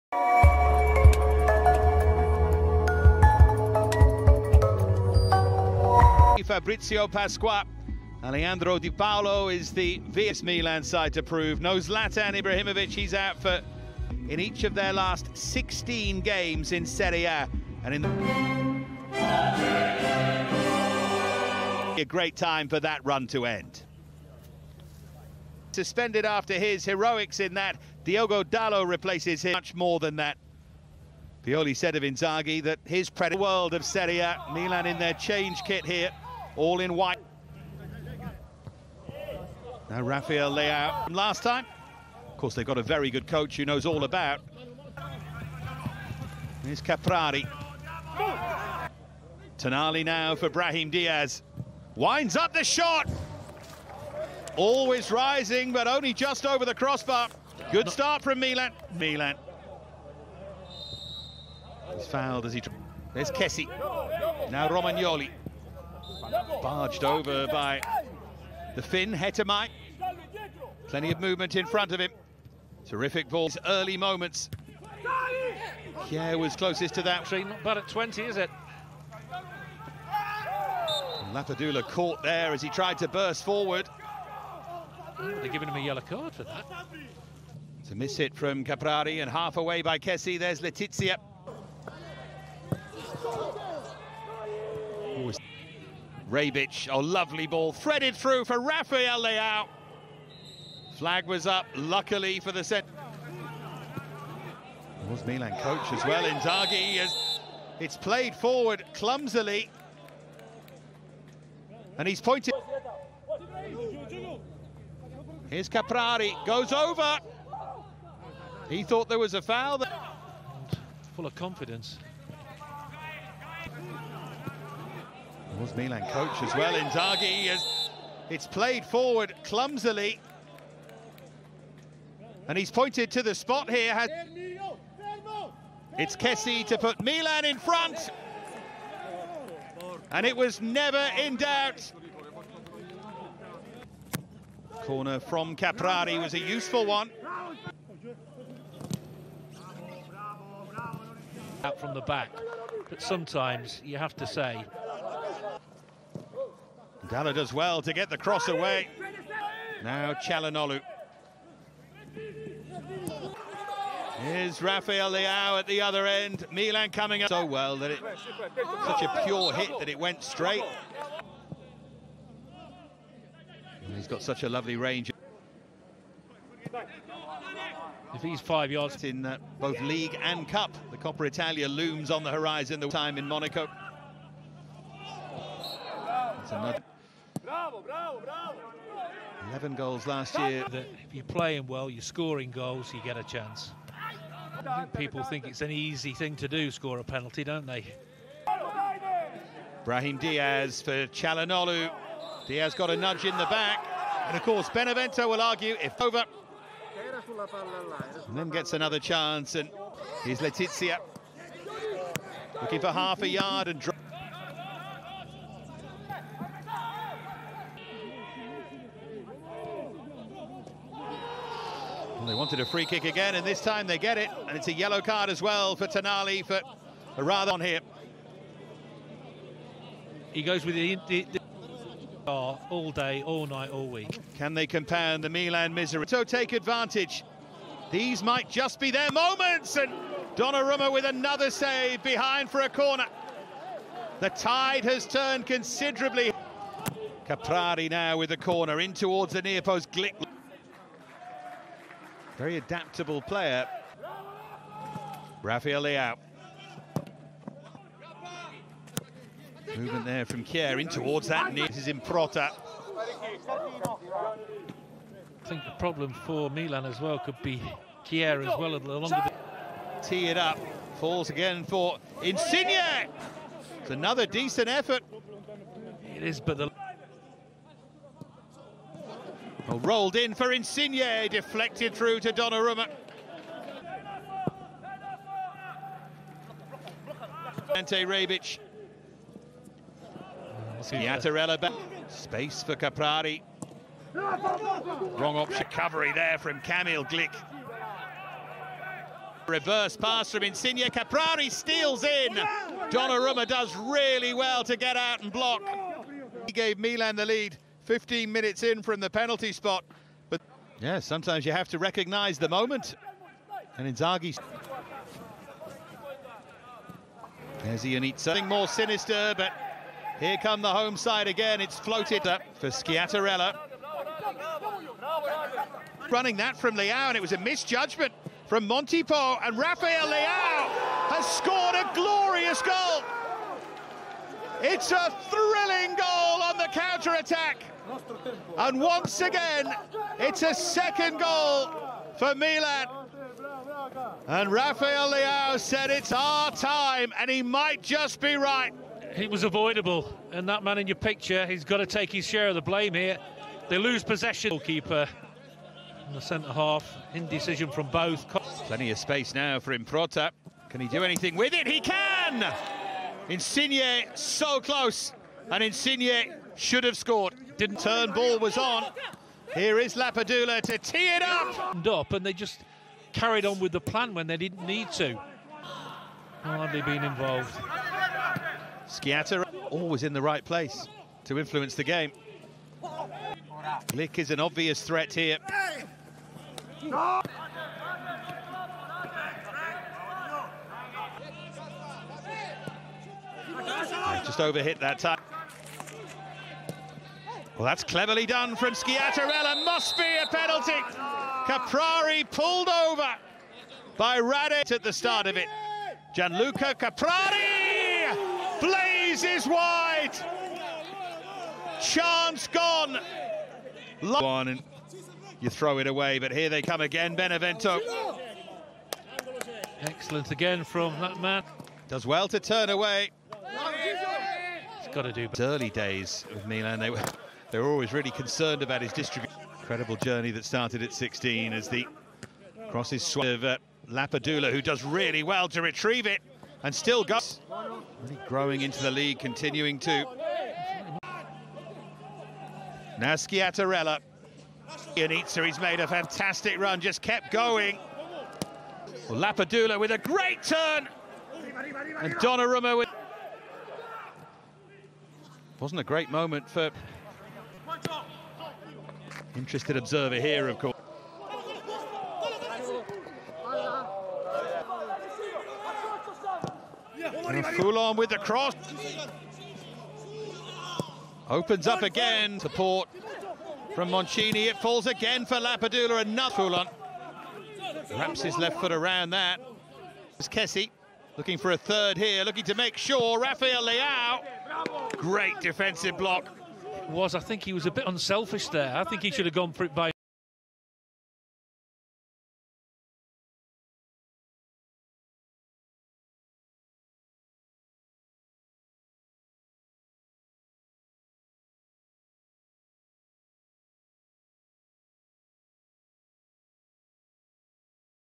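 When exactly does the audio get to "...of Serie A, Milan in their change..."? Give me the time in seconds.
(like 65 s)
33 s.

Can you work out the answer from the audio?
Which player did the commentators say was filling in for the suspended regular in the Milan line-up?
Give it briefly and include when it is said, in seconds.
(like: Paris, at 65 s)
Diogo Dalot, at 28 s.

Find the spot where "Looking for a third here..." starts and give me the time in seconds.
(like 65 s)
481 s.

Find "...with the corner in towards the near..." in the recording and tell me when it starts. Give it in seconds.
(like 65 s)
248 s.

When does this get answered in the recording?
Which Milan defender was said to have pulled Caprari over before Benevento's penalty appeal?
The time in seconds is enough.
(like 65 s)
404 s.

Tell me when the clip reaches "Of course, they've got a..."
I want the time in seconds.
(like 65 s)
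42 s.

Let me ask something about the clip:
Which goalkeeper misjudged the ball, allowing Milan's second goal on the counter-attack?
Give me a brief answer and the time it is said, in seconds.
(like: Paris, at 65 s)
Montipo, at 328 s.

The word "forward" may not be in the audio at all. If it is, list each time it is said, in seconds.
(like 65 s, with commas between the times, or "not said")
83 s, 108 s, 128 s.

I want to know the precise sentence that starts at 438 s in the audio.
Really growing into the league, continuing to.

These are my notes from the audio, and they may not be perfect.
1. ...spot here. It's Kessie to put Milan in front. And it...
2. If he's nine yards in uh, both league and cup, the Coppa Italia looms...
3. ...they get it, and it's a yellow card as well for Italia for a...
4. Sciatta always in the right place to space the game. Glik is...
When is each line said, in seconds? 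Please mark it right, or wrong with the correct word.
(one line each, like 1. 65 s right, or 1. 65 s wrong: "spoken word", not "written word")
1. 133 s right
2. 178 s wrong: "five", not "nine"
3. 223 s wrong: "Tonali", not "Italia"
4. 378 s wrong: "influence", not "space".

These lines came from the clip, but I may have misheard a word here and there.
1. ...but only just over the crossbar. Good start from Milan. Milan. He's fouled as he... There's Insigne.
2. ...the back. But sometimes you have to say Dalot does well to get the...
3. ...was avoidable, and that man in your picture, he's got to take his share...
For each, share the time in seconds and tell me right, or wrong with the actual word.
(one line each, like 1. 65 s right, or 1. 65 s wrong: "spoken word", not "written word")
1. 55 s wrong: "Kessie", not "Insigne"
2. 151 s right
3. 349 s right.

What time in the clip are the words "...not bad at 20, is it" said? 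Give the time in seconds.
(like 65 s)
77 s.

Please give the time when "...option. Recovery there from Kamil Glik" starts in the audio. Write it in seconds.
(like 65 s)
295 s.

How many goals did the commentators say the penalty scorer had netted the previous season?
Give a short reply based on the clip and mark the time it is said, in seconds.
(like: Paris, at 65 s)
11, at 189 s.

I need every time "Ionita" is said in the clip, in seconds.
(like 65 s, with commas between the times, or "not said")
317 s, 444 s.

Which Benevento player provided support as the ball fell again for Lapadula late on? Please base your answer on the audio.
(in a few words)
Moncini.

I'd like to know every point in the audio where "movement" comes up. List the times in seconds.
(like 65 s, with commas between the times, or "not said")
71 s, 259 s.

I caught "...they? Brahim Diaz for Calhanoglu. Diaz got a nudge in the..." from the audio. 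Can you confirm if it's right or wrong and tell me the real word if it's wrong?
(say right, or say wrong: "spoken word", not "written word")
right.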